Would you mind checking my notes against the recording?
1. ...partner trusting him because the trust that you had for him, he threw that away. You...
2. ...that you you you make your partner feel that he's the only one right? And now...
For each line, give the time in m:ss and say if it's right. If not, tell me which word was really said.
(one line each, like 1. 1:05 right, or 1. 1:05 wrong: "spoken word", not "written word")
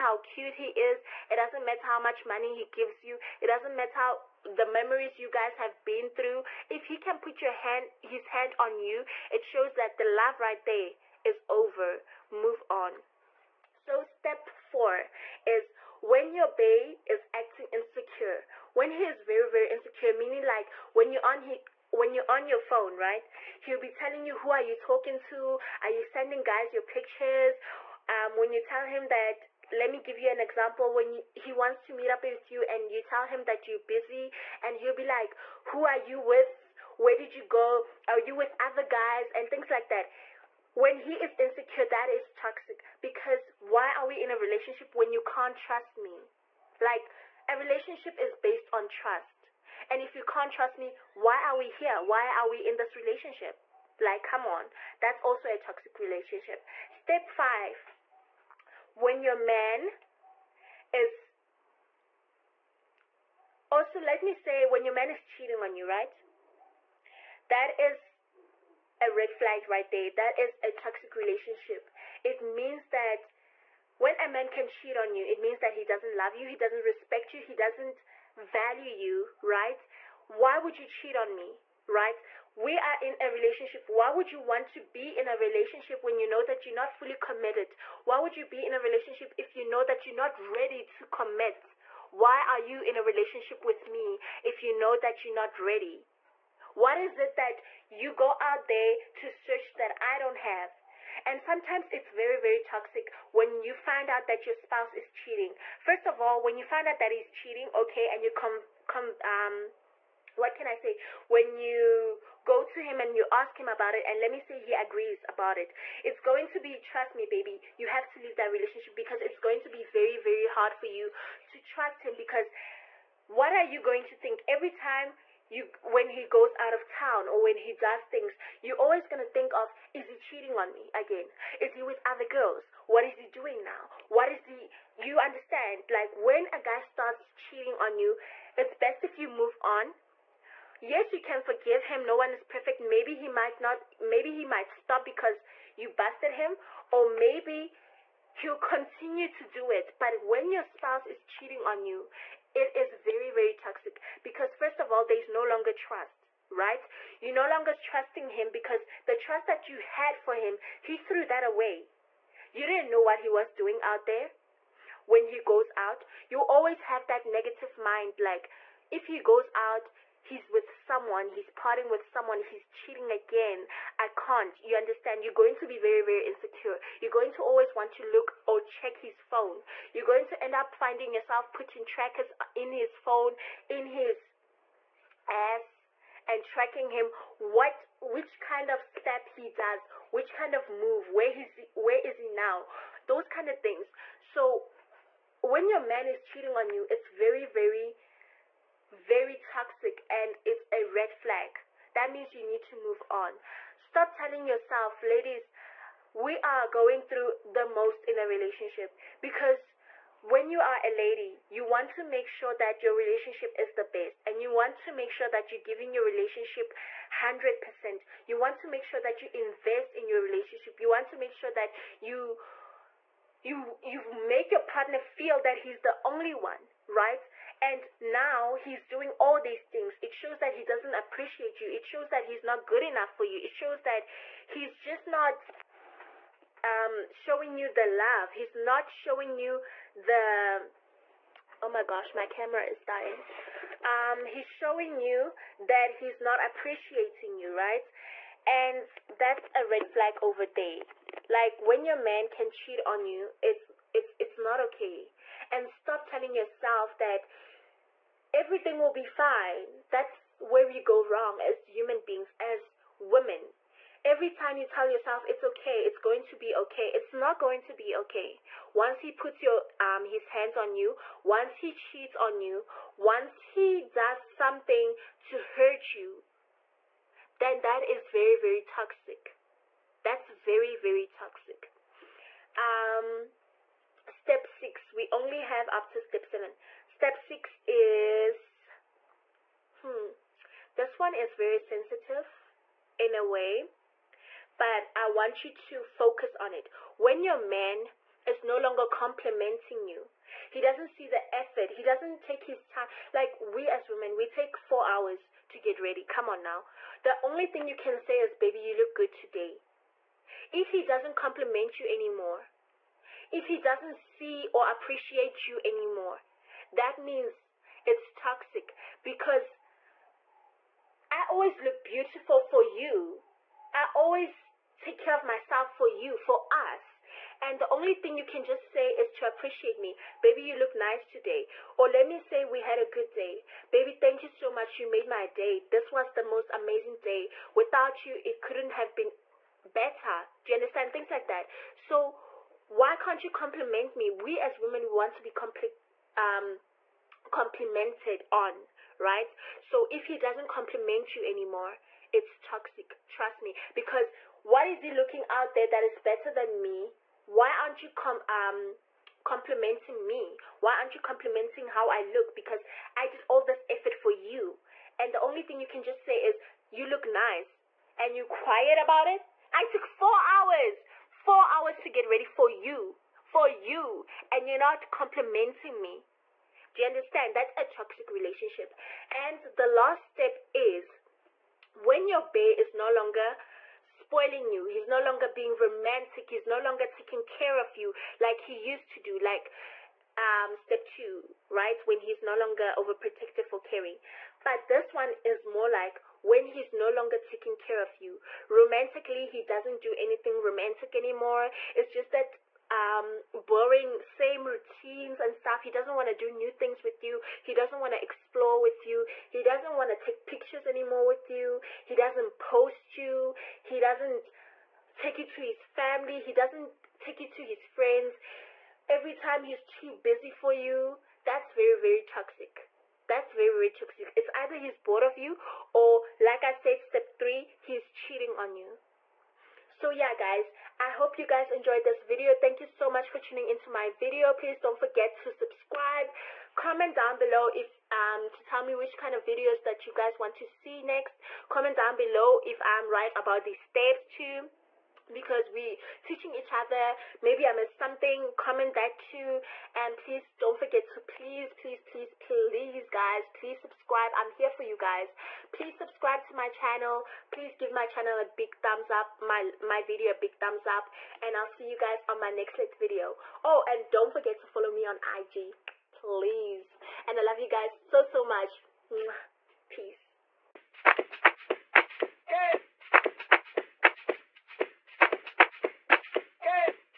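1. 2:37 wrong: "longer", not "partner"
2. 3:41 right.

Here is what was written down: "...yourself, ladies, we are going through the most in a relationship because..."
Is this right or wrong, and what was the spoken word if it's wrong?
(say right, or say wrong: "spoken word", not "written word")
right.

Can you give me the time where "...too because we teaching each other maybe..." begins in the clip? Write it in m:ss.
7:24.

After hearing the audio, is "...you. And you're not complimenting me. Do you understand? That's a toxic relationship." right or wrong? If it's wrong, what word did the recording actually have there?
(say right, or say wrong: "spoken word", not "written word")
right.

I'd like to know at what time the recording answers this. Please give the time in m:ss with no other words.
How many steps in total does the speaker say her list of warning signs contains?
4:46.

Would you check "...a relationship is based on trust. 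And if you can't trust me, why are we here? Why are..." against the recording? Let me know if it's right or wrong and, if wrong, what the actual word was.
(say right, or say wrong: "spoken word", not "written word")
right.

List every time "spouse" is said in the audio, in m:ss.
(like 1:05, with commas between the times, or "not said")
1:44, 2:30.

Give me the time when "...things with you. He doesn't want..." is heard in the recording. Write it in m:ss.
6:46.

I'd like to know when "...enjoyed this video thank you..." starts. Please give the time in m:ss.
7:11.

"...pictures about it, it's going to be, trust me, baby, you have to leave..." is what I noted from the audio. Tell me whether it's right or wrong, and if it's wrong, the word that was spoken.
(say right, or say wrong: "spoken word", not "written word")
wrong: "agrees", not "pictures".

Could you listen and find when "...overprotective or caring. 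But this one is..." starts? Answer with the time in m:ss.
6:32.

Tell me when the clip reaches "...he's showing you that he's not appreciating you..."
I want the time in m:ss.
4:04.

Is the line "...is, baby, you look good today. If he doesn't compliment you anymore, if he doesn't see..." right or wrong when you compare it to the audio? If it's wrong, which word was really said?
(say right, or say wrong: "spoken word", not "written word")
right.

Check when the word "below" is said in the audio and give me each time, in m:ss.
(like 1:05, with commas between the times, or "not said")
7:17, 7:21.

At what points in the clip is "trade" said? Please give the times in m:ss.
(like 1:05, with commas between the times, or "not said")
not said.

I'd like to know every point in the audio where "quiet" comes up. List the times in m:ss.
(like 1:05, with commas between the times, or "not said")
6:08.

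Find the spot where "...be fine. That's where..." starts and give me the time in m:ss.
4:18.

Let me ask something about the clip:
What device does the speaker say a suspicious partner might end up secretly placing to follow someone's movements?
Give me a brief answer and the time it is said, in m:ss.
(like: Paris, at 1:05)
trackers, at 3:01.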